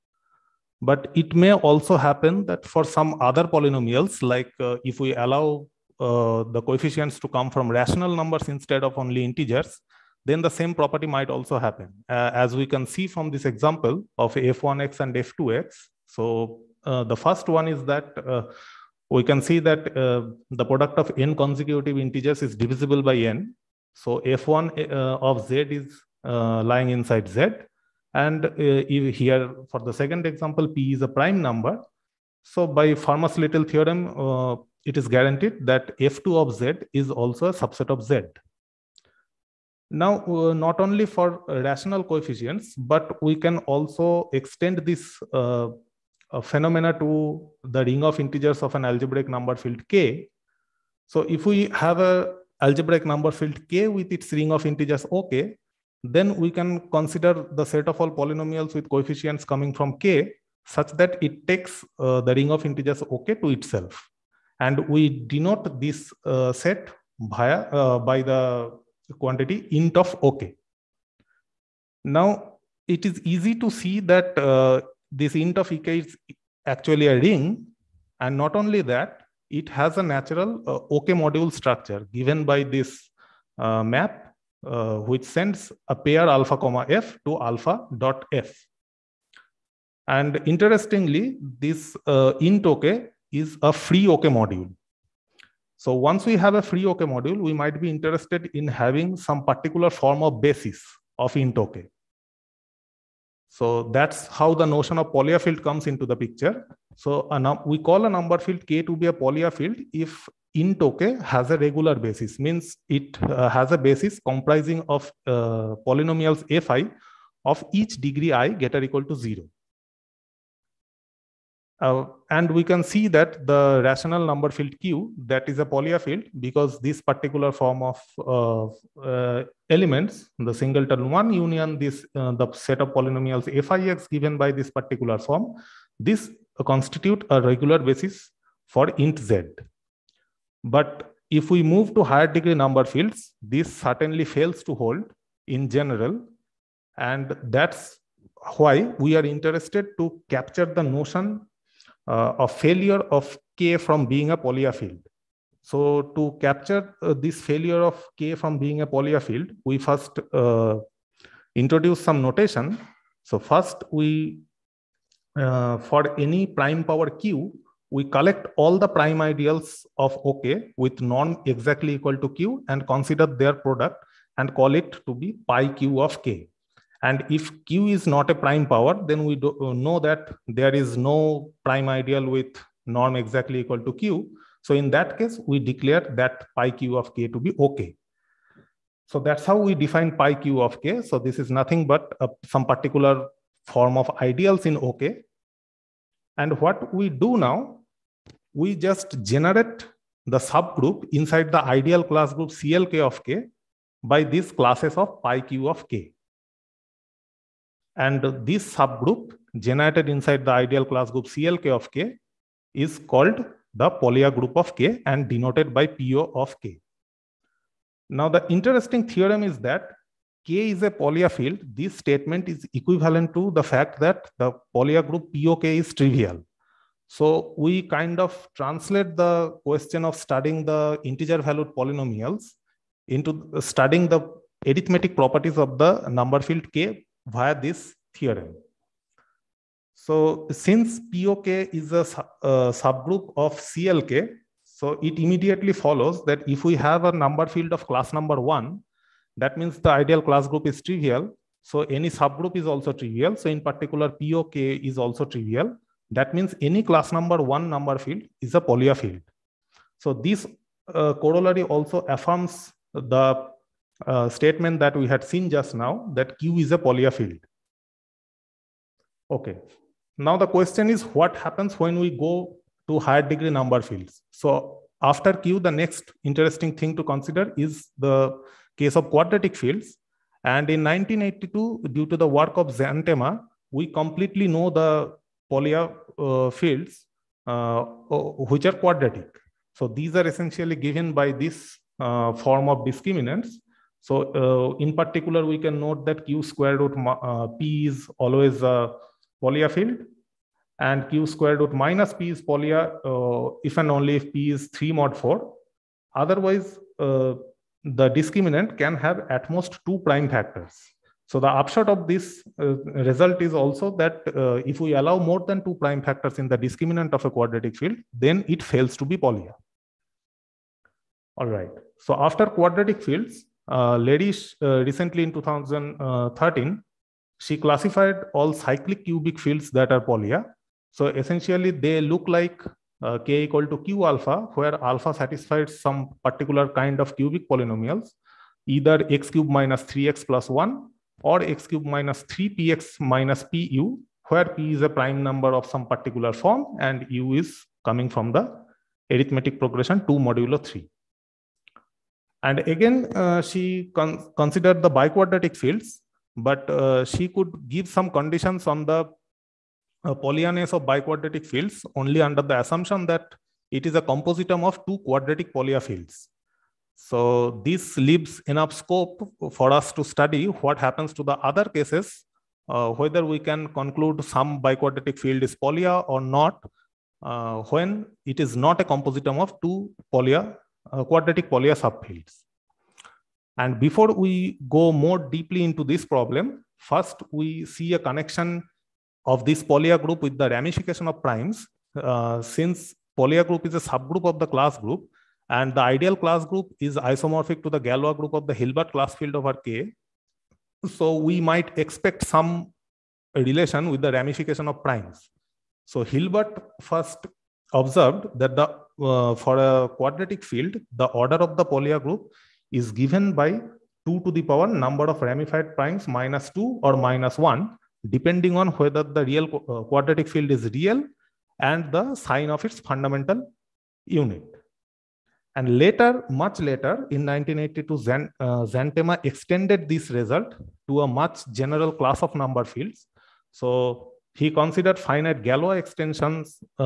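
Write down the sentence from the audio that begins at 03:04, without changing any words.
So in that case, we declare that pi Q of K to be okay.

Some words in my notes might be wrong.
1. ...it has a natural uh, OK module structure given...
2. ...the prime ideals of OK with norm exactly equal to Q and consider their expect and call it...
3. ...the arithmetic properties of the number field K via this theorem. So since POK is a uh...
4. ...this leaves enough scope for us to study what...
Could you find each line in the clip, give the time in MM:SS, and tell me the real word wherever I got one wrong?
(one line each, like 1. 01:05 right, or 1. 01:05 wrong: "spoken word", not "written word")
1. 01:19 right
2. 02:48 wrong: "product", not "expect"
3. 03:54 right
4. 06:07 right.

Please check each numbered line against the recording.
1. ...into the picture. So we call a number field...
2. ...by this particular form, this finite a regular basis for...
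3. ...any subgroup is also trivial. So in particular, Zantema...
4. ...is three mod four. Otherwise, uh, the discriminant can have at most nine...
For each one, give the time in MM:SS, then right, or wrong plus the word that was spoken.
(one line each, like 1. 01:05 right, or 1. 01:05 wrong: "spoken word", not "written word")
1. 01:45 right
2. 02:14 wrong: "constitute", not "finite"
3. 04:11 wrong: "POK", not "Zantema"
4. 05:04 wrong: "two", not "nine".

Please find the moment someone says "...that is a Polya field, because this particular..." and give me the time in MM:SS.
02:05.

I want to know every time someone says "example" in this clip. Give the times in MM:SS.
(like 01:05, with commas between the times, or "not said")
00:13, 00:30.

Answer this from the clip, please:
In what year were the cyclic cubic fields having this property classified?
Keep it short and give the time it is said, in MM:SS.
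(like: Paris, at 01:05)
2013, at 05:25.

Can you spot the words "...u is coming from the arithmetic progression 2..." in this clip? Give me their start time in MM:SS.
05:47.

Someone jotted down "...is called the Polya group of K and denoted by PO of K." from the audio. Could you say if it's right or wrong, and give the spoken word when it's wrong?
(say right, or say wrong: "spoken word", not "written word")
right.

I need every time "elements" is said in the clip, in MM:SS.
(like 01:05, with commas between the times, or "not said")
02:09.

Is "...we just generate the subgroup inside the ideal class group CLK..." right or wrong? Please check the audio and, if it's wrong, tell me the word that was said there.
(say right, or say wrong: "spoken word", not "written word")
right.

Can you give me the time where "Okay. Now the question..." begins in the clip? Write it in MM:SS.
04:29.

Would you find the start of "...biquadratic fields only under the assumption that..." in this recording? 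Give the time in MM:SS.
06:00.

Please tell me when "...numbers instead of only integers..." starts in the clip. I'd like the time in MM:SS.
00:08.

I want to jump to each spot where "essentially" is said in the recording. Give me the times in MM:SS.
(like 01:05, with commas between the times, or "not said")
04:50, 05:31.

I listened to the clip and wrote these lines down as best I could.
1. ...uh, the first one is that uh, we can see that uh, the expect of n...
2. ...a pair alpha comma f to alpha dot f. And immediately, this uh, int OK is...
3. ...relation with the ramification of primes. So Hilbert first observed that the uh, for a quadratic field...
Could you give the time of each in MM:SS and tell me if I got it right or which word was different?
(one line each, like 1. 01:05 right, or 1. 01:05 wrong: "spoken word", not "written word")
1. 00:16 wrong: "product", not "expect"
2. 01:25 wrong: "interestingly", not "immediately"
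3. 06:43 right.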